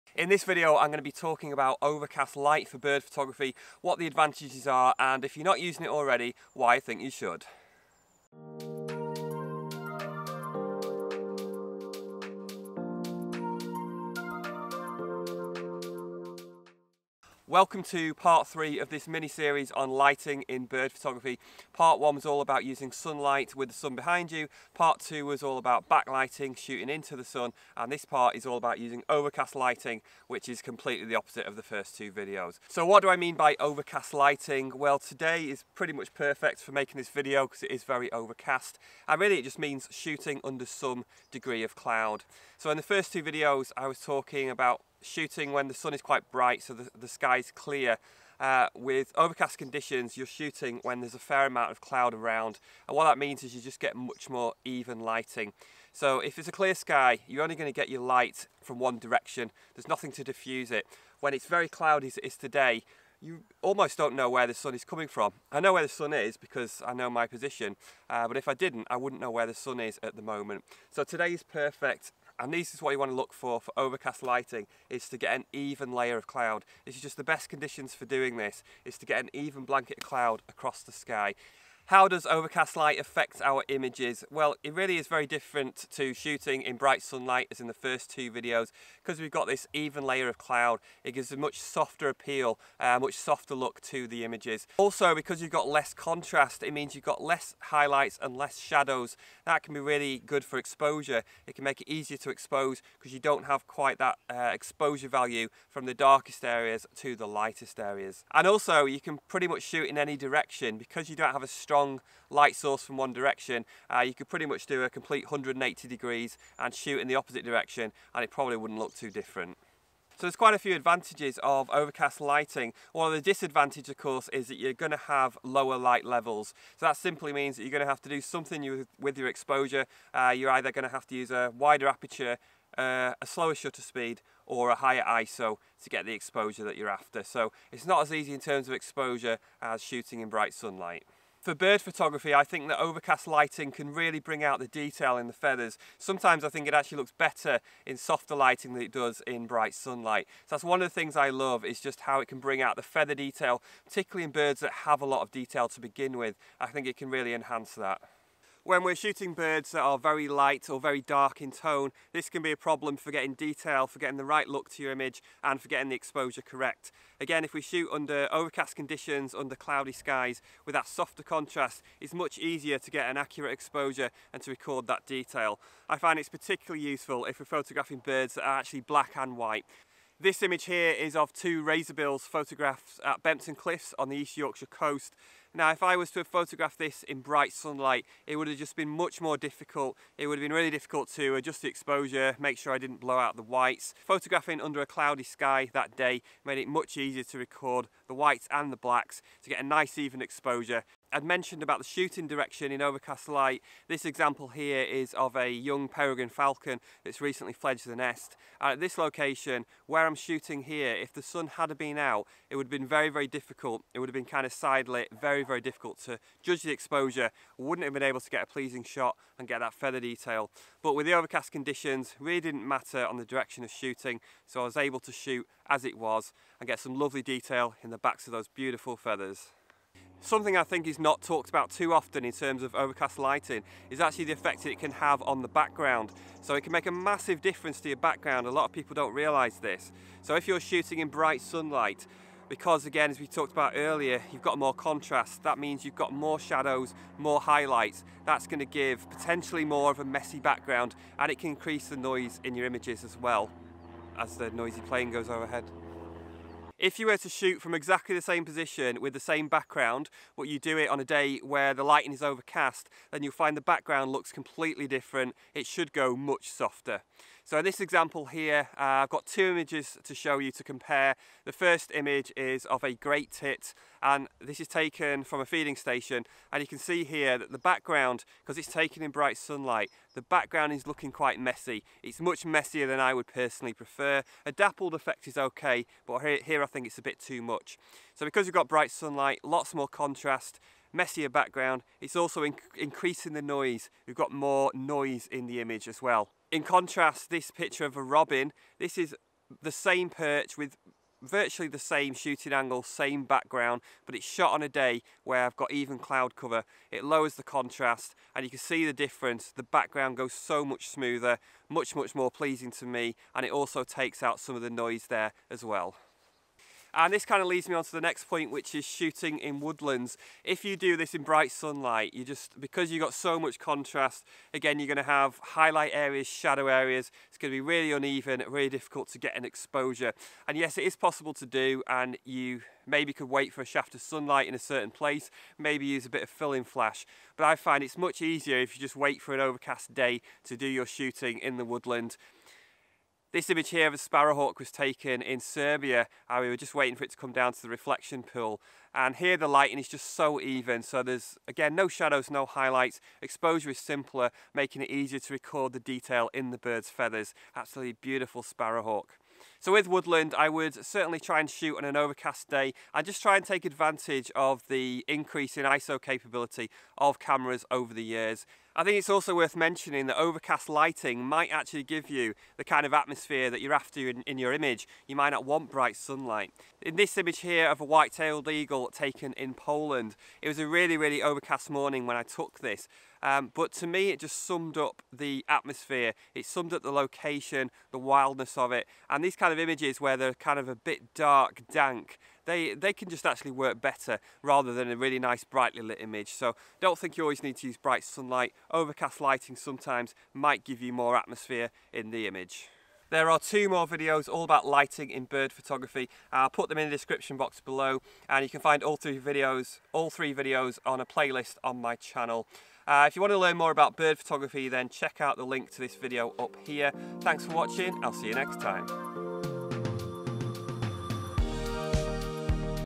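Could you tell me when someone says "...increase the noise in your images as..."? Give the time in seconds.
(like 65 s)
251 s.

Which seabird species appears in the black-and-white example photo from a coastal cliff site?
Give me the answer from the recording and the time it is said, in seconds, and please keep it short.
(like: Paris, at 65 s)
Razorbills, at 181 s.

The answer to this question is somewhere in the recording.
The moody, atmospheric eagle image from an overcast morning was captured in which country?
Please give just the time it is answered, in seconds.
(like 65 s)
379 s.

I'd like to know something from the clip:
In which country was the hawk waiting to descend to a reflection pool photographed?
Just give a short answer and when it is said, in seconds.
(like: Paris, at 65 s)
Serbia, at 345 s.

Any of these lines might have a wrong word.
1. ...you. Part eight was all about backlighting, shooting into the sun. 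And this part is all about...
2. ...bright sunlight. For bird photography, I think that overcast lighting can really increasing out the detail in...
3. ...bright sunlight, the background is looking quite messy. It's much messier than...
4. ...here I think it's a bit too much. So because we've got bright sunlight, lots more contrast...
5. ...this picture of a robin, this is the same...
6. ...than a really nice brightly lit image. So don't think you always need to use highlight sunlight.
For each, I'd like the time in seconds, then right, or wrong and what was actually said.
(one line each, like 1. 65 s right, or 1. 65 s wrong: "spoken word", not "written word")
1. 24 s wrong: "two", not "eight"
2. 140 s wrong: "bring", not "increasing"
3. 279 s right
4. 286 s right
5. 297 s right
6. 394 s wrong: "bright", not "highlight".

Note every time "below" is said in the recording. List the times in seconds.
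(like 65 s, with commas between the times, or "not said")
407 s.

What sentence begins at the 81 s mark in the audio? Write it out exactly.
How does overcast light affect our images?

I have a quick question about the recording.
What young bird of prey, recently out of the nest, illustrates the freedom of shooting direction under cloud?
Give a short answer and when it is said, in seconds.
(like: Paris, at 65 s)
Peregrine falcon, at 205 s.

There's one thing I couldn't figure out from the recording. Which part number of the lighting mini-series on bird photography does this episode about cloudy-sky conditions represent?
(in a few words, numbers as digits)
3.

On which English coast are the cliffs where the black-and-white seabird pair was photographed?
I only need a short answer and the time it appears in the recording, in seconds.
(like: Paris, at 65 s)
East Yorkshire, at 184 s.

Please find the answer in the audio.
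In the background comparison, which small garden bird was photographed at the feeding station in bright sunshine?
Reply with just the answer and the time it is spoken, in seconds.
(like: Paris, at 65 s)
Great tit, at 272 s.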